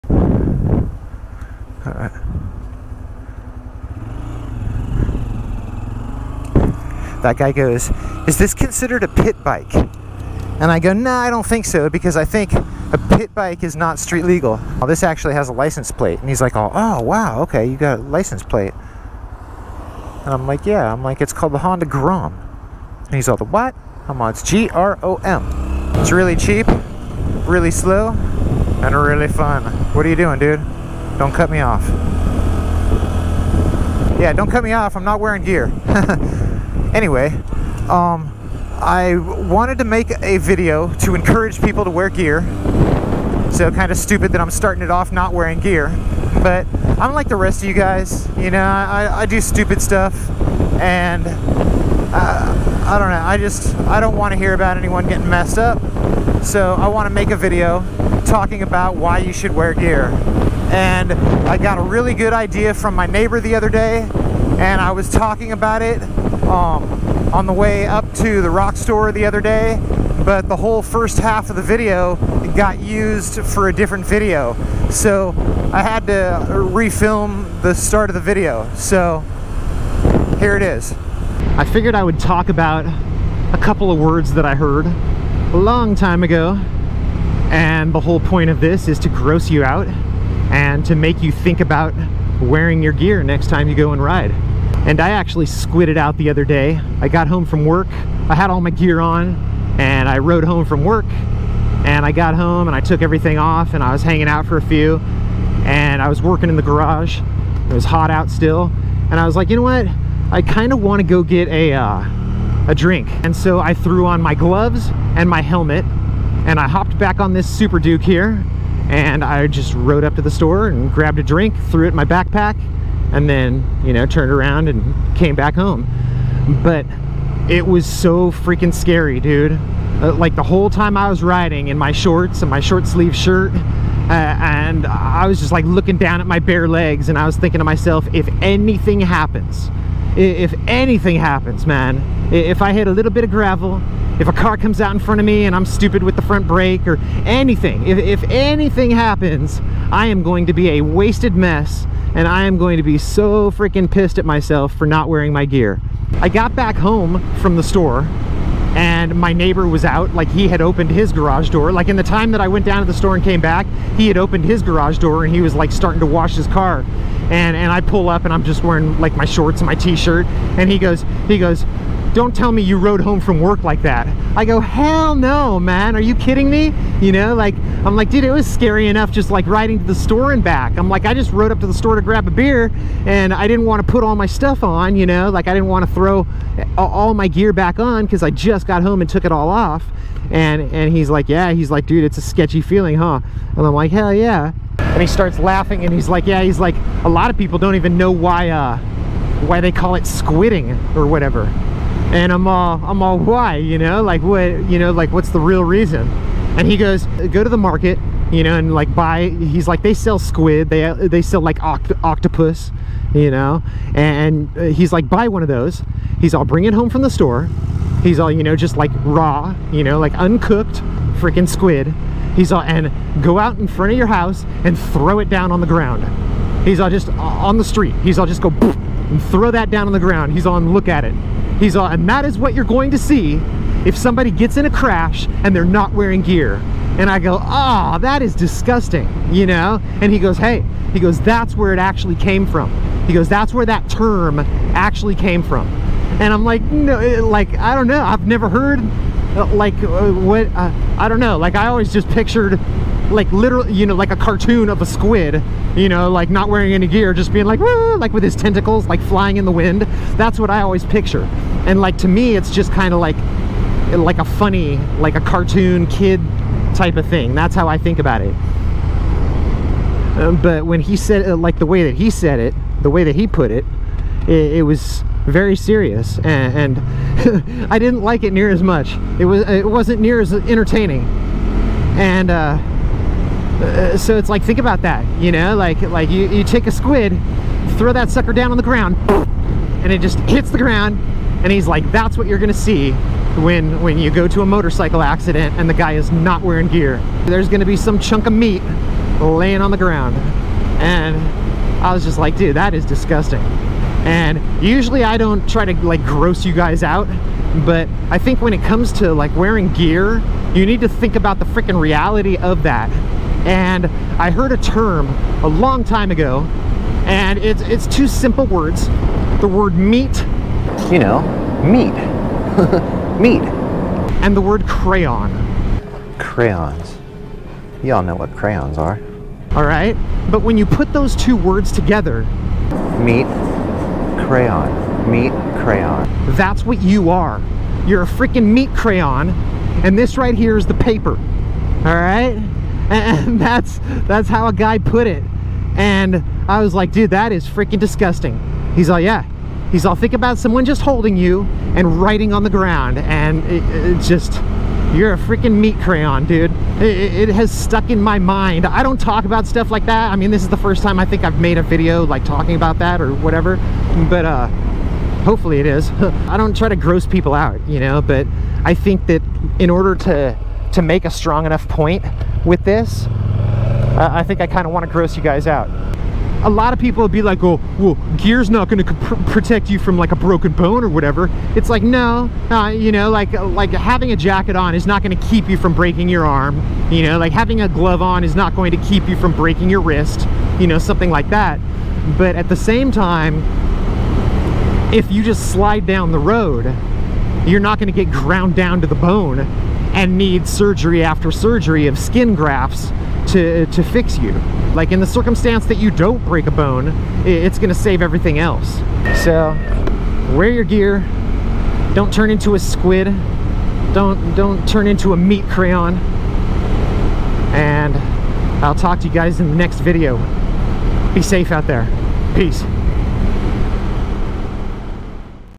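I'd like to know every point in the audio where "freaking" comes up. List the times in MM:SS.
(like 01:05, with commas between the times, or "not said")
02:08, 02:33, 03:41, 05:11, 05:38, 05:47, 05:55.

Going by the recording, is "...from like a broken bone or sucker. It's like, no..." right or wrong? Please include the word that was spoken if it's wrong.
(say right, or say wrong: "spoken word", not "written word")
wrong: "whatever", not "sucker".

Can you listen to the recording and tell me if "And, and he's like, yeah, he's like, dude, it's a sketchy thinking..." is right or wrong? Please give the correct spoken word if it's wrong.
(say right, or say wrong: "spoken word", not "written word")
wrong: "feeling", not "thinking".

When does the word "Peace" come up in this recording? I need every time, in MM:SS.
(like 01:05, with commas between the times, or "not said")
07:02.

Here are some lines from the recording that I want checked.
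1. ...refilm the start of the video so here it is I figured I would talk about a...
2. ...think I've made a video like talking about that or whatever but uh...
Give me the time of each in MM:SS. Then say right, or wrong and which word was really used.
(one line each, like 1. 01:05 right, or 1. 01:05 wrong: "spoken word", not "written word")
1. 01:16 right
2. 06:01 right.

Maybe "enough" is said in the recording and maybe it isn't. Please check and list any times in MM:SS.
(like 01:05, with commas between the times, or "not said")
02:58, 06:11.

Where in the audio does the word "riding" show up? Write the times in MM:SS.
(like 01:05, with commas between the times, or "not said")
02:11, 02:59.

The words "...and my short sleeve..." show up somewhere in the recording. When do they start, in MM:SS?
02:12.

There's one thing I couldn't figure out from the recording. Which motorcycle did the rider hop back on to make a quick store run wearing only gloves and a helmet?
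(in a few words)
Super Duke.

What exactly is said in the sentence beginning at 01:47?
It was hot out still, and I was like, you know what?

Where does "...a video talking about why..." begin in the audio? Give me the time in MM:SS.
00:57.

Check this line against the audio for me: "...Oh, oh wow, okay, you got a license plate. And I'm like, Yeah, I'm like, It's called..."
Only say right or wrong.
right.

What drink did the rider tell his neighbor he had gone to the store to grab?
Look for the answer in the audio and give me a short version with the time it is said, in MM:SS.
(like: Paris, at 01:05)
A beer, at 03:02.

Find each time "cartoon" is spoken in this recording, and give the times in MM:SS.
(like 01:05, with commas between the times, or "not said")
04:14, 04:25.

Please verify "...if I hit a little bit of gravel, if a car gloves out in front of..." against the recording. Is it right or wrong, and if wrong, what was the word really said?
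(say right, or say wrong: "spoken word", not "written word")
wrong: "comes", not "gloves".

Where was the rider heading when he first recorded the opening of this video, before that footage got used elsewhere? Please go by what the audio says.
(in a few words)
The Rock Store.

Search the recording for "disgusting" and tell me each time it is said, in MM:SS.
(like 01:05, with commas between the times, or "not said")
03:58, 05:02, 05:47.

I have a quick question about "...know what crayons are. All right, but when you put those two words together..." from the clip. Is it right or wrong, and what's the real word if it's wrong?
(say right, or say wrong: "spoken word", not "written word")
right.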